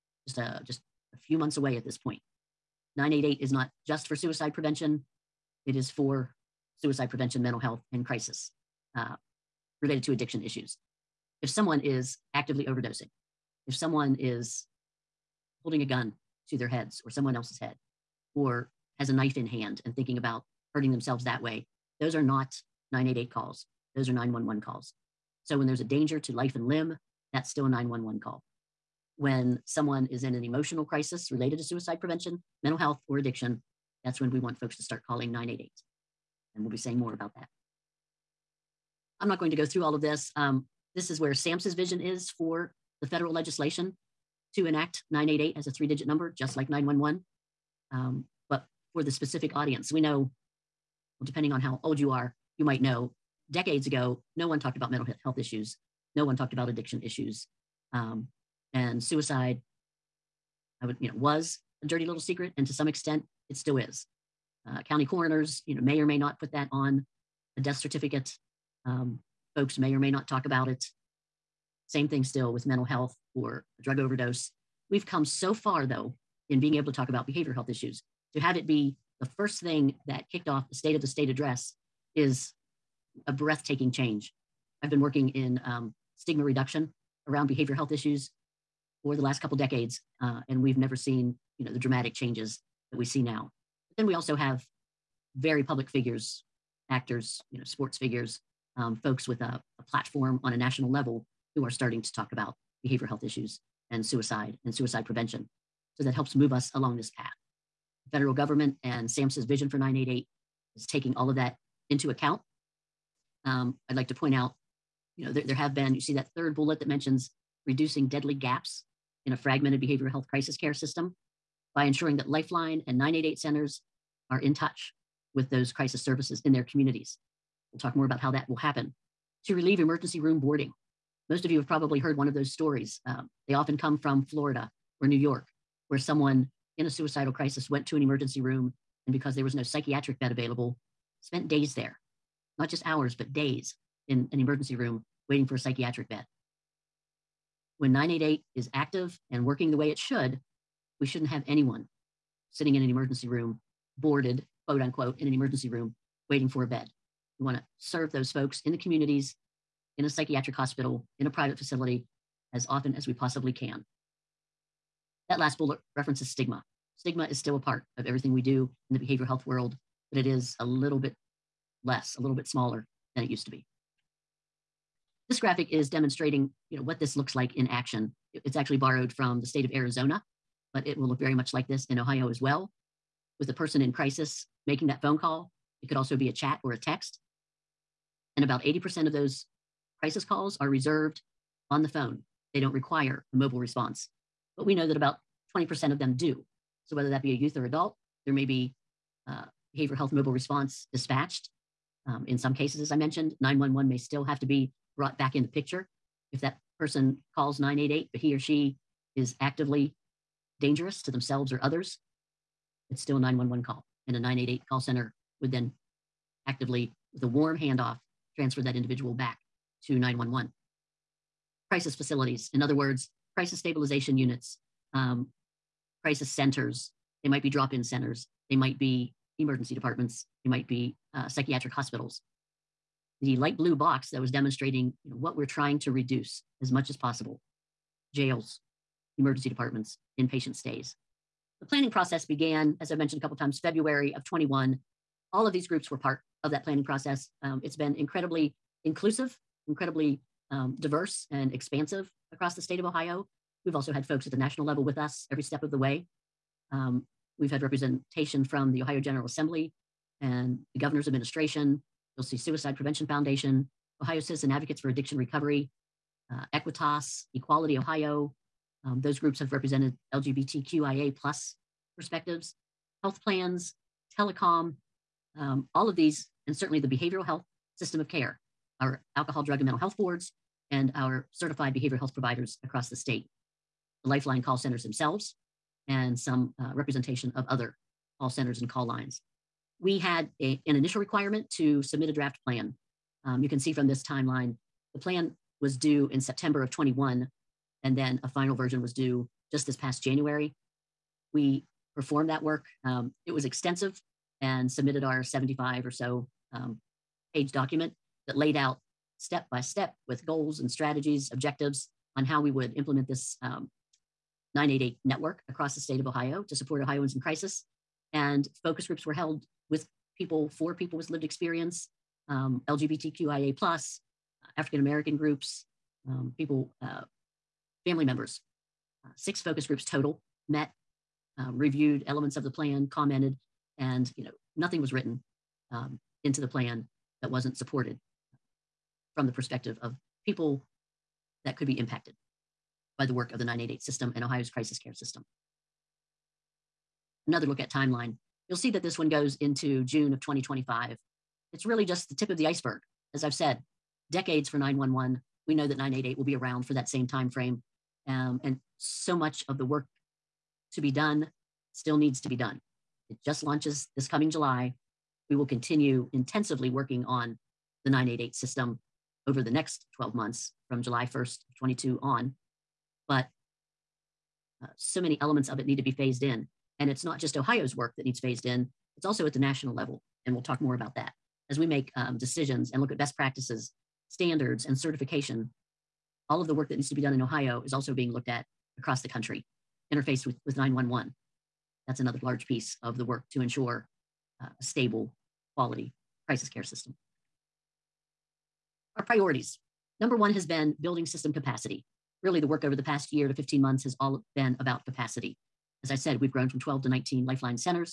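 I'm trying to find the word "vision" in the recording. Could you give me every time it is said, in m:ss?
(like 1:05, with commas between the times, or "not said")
0:41, 1:49.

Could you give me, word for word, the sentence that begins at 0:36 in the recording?
And we'll be saying more about that.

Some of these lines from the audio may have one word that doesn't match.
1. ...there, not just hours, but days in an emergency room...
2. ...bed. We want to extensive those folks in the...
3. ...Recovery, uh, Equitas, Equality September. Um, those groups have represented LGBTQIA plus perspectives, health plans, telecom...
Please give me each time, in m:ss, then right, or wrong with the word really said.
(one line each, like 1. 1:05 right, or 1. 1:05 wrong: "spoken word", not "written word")
1. 2:21 right
2. 2:36 wrong: "serve", not "extensive"
3. 4:25 wrong: "Ohio", not "September".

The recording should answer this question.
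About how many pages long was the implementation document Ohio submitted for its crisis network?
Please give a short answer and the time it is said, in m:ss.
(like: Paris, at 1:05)
75, at 5:05.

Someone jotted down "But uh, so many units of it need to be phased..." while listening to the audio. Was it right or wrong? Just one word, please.
wrong.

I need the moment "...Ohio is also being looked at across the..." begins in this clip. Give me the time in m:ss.
6:27.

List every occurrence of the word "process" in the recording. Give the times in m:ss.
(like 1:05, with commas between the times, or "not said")
4:01, 4:06.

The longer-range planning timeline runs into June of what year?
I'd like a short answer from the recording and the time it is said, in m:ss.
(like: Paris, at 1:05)
2025, at 5:50.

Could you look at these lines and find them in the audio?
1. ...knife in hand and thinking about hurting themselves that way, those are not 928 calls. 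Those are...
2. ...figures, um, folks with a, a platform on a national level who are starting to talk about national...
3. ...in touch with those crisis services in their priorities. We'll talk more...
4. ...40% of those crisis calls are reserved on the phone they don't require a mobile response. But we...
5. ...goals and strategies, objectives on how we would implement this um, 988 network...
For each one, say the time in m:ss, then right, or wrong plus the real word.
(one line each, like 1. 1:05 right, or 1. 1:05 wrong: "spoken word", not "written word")
1. 0:19 wrong: "988", not "928"
2. 1:37 wrong: "behavioral", not "national"
3. 2:04 wrong: "communities", not "priorities"
4. 3:08 wrong: "80", not "40"
5. 5:10 right.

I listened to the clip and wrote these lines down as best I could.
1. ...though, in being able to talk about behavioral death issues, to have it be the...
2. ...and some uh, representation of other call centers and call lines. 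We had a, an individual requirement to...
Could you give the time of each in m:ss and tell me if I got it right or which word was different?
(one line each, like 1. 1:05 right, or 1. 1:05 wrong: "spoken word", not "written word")
1. 1:15 wrong: "health", not "death"
2. 4:45 wrong: "initial", not "individual".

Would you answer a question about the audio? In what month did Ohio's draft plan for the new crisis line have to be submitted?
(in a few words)
September.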